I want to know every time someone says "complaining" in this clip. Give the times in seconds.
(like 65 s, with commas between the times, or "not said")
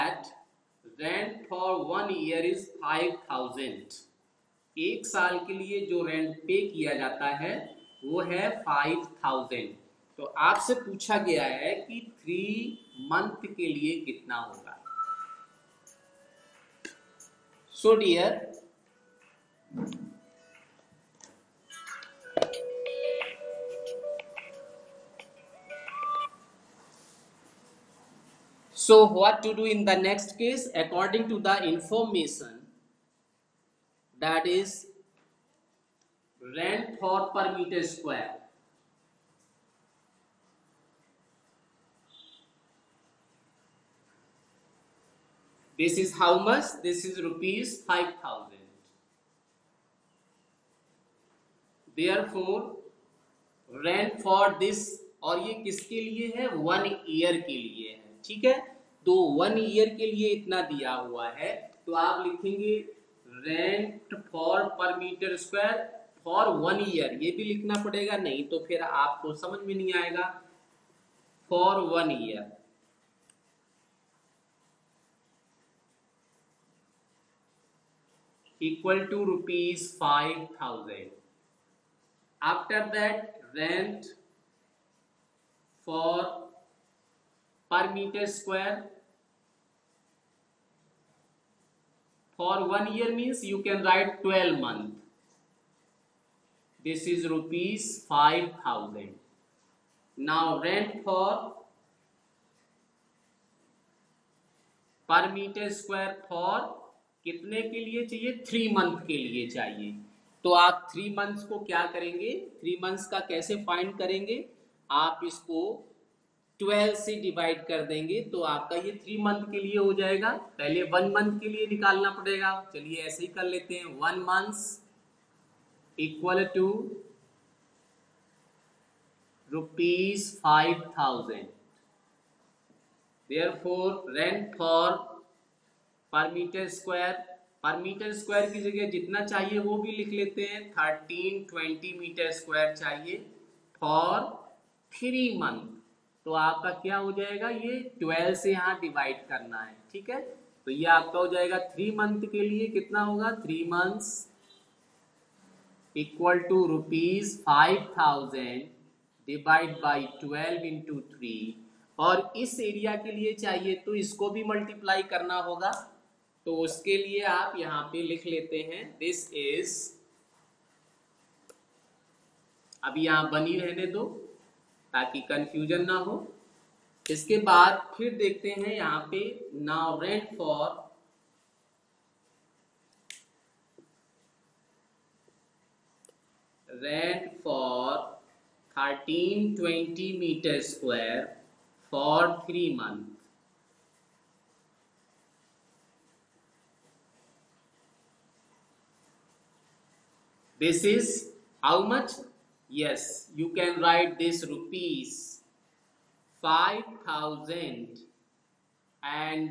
not said.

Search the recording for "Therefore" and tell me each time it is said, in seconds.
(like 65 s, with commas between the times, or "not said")
52 s.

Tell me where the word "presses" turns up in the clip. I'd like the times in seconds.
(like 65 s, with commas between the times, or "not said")
not said.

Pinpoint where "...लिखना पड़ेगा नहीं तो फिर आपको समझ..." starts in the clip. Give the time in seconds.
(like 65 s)
67 s.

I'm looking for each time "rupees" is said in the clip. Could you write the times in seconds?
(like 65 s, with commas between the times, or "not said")
47 s, 97 s, 204 s.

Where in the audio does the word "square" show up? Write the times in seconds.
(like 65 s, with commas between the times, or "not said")
37 s.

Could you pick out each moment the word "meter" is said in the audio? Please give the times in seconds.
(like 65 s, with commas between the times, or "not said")
37 s.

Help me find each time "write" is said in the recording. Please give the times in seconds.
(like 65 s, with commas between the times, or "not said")
93 s, 203 s.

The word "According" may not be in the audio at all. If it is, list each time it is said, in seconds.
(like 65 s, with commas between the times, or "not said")
30 s.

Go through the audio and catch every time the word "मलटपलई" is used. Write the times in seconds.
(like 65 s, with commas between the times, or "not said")
164 s.